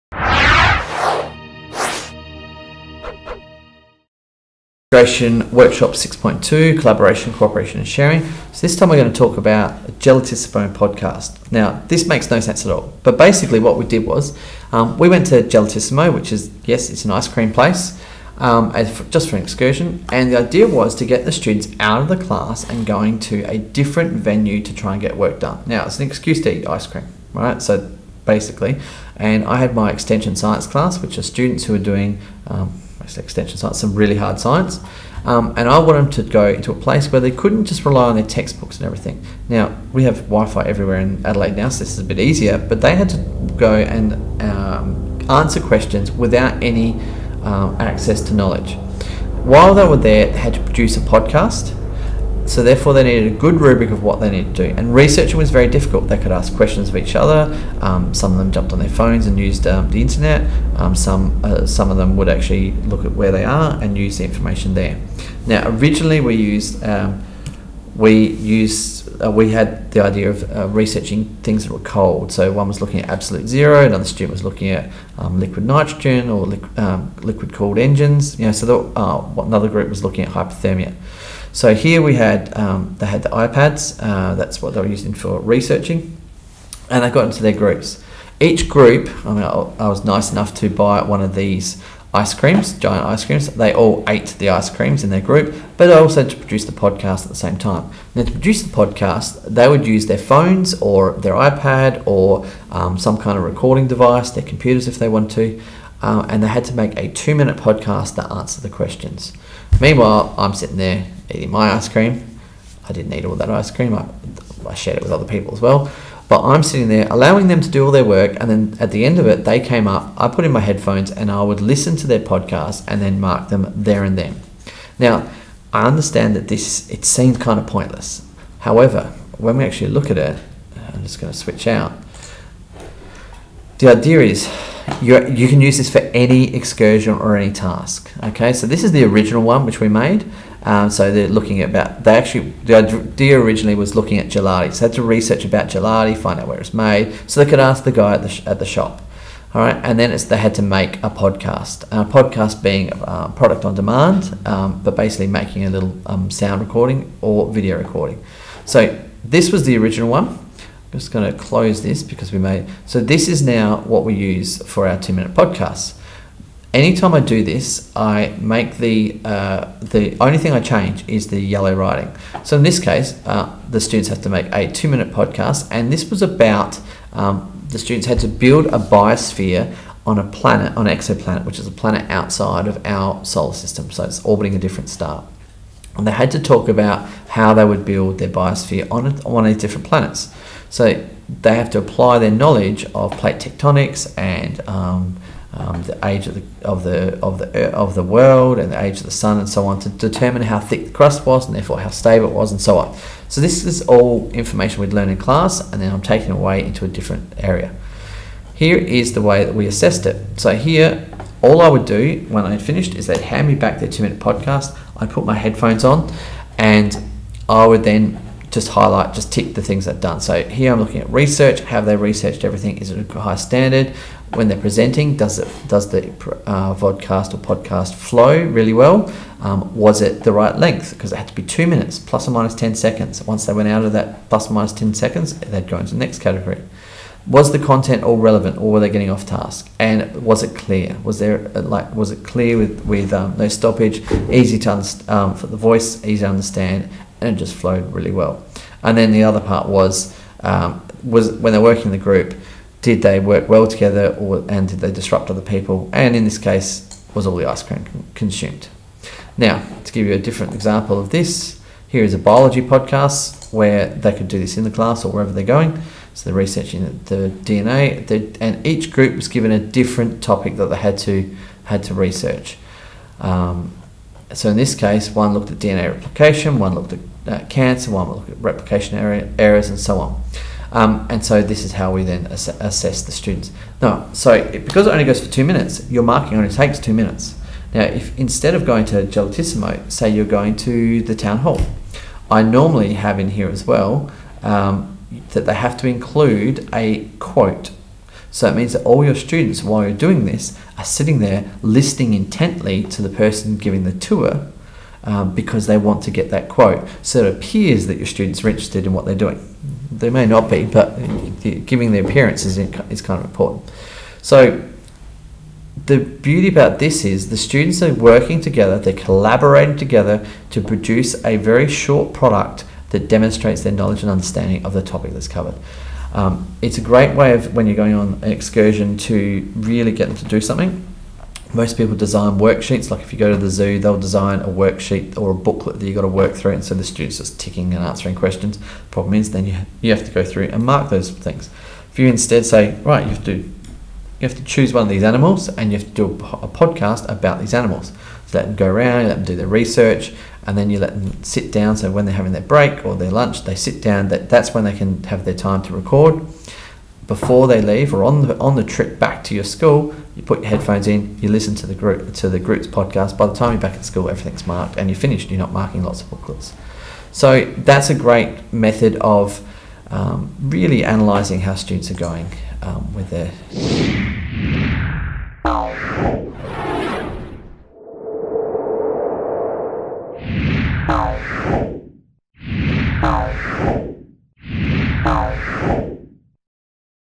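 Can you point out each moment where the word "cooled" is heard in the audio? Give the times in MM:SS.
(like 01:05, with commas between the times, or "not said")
01:17.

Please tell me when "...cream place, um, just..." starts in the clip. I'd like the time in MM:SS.
00:17.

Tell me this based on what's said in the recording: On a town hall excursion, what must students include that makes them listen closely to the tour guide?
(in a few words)
a quote.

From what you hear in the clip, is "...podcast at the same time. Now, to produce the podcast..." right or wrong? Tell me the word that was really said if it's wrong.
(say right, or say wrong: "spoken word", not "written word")
right.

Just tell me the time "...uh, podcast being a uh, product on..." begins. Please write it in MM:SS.
02:32.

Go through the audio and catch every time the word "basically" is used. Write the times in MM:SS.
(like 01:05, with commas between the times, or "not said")
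00:13, 00:28, 02:34.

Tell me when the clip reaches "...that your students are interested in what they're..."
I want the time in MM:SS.
05:07.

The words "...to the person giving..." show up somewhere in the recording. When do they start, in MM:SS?
05:02.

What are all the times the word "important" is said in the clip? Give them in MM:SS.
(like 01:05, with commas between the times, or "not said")
05:13.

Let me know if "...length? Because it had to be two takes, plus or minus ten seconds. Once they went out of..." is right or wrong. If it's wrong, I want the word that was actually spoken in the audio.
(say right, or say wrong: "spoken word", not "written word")
wrong: "minutes", not "takes".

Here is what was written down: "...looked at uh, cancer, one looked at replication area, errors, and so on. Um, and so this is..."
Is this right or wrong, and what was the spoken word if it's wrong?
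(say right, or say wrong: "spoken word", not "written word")
right.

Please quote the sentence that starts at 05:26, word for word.
Um, it's a great way of when you're going on an excursion to really get them to do something.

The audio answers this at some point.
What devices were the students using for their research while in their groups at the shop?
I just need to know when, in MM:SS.
01:23.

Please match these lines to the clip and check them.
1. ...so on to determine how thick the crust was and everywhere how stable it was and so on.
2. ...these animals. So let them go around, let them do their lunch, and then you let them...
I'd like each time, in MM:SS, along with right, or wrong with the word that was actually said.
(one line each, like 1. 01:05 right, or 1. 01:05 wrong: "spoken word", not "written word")
1. 03:19 wrong: "therefore", not "everywhere"
2. 05:47 wrong: "research", not "lunch".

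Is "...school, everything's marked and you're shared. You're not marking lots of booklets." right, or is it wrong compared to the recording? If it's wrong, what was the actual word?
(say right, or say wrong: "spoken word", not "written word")
wrong: "finished", not "shared".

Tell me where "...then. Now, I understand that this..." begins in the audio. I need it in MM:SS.
02:04.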